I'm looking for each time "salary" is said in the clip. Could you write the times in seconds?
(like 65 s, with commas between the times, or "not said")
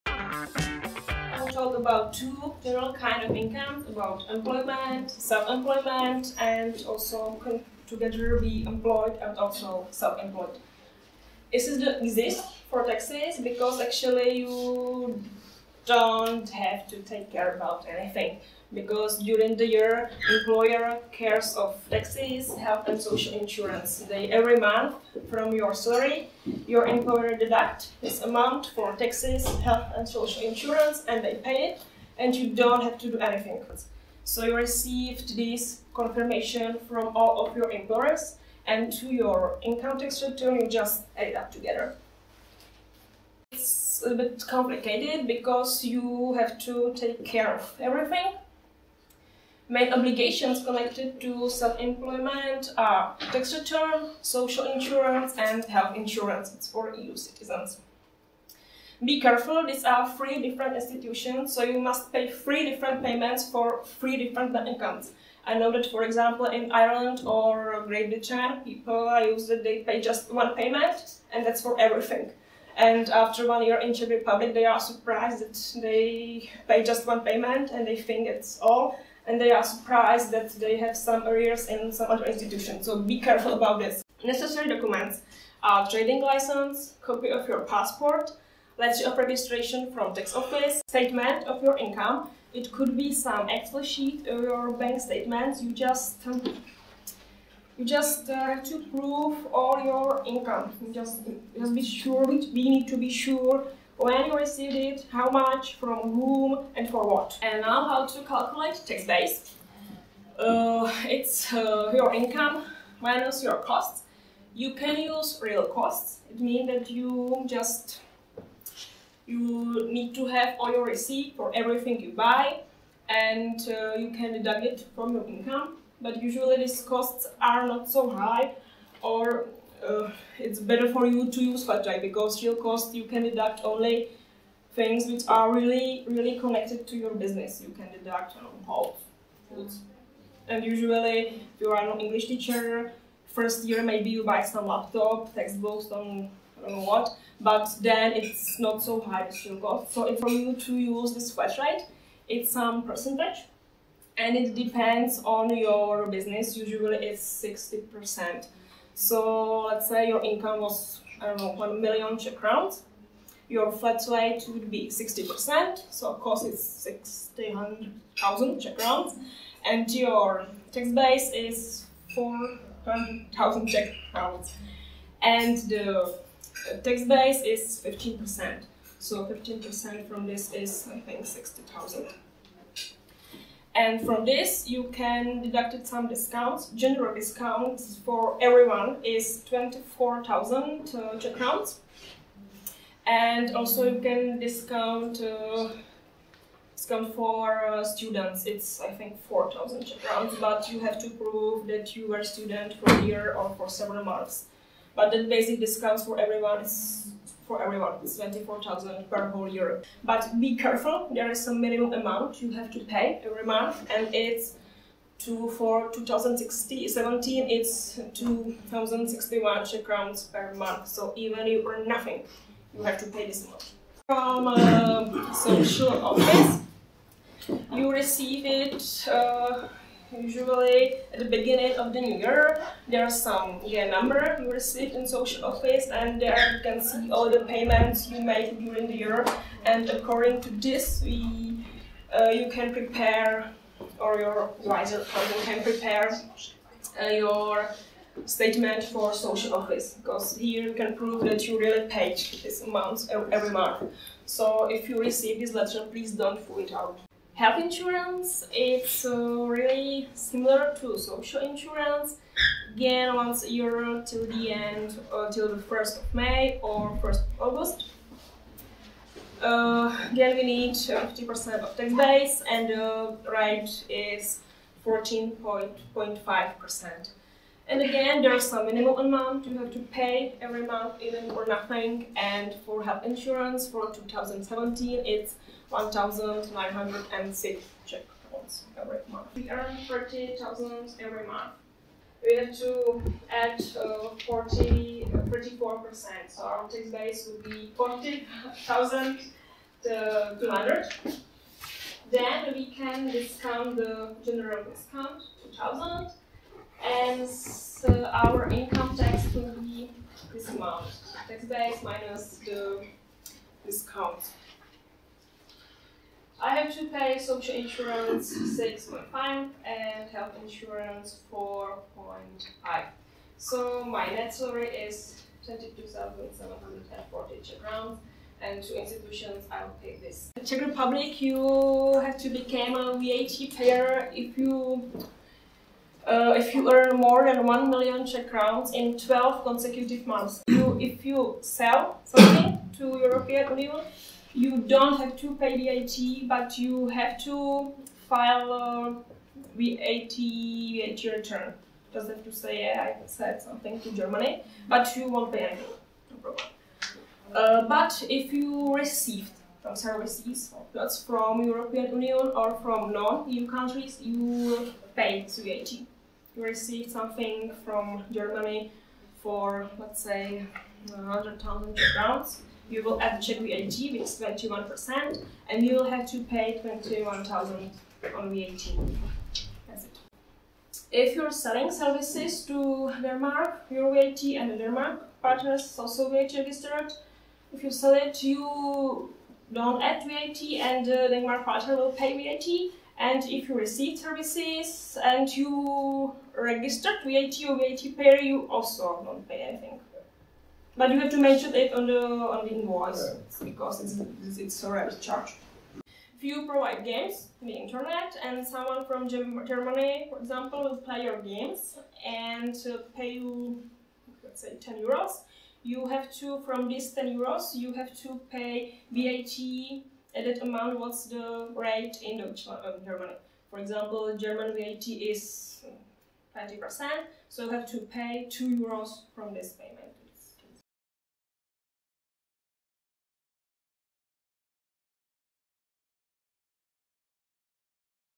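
25 s, 324 s.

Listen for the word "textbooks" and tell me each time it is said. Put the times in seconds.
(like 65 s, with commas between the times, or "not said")
145 s.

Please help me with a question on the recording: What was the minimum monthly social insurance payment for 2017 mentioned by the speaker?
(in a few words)
2061 Czech crowns.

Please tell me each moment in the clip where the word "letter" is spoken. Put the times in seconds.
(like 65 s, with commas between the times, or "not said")
88 s, 255 s.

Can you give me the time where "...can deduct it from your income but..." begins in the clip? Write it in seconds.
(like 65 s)
124 s.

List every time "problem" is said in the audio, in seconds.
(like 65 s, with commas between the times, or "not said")
356 s.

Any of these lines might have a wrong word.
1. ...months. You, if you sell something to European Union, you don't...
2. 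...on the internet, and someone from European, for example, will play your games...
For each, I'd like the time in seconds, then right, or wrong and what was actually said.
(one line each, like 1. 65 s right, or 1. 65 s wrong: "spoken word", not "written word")
1. 340 s right
2. 407 s wrong: "Germany", not "European".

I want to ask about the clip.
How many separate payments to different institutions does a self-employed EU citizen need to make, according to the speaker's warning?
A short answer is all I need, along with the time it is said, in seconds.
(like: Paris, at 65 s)
3, at 62 s.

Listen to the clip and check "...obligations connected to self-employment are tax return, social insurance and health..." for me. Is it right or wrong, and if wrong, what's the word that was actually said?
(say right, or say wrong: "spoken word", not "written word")
right.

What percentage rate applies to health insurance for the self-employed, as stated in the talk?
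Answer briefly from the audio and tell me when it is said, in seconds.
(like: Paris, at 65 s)
14.5%, at 274 s.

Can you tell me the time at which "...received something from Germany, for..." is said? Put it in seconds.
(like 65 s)
366 s.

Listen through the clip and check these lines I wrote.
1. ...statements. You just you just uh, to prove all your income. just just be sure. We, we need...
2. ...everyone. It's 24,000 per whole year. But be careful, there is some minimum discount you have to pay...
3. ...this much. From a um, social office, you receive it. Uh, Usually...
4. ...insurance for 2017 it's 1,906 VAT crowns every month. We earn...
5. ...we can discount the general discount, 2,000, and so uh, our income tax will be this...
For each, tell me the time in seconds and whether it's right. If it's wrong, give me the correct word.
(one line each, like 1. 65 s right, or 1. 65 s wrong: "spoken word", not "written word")
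1. 95 s right
2. 207 s wrong: "amount", not "discount"
3. 223 s right
4. 283 s wrong: "Czech", not "VAT"
5. 302 s right.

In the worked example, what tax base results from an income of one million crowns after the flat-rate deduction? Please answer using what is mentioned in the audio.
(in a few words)
400,000 Czech crowns.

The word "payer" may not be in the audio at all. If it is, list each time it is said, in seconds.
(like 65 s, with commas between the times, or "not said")
333 s, 397 s.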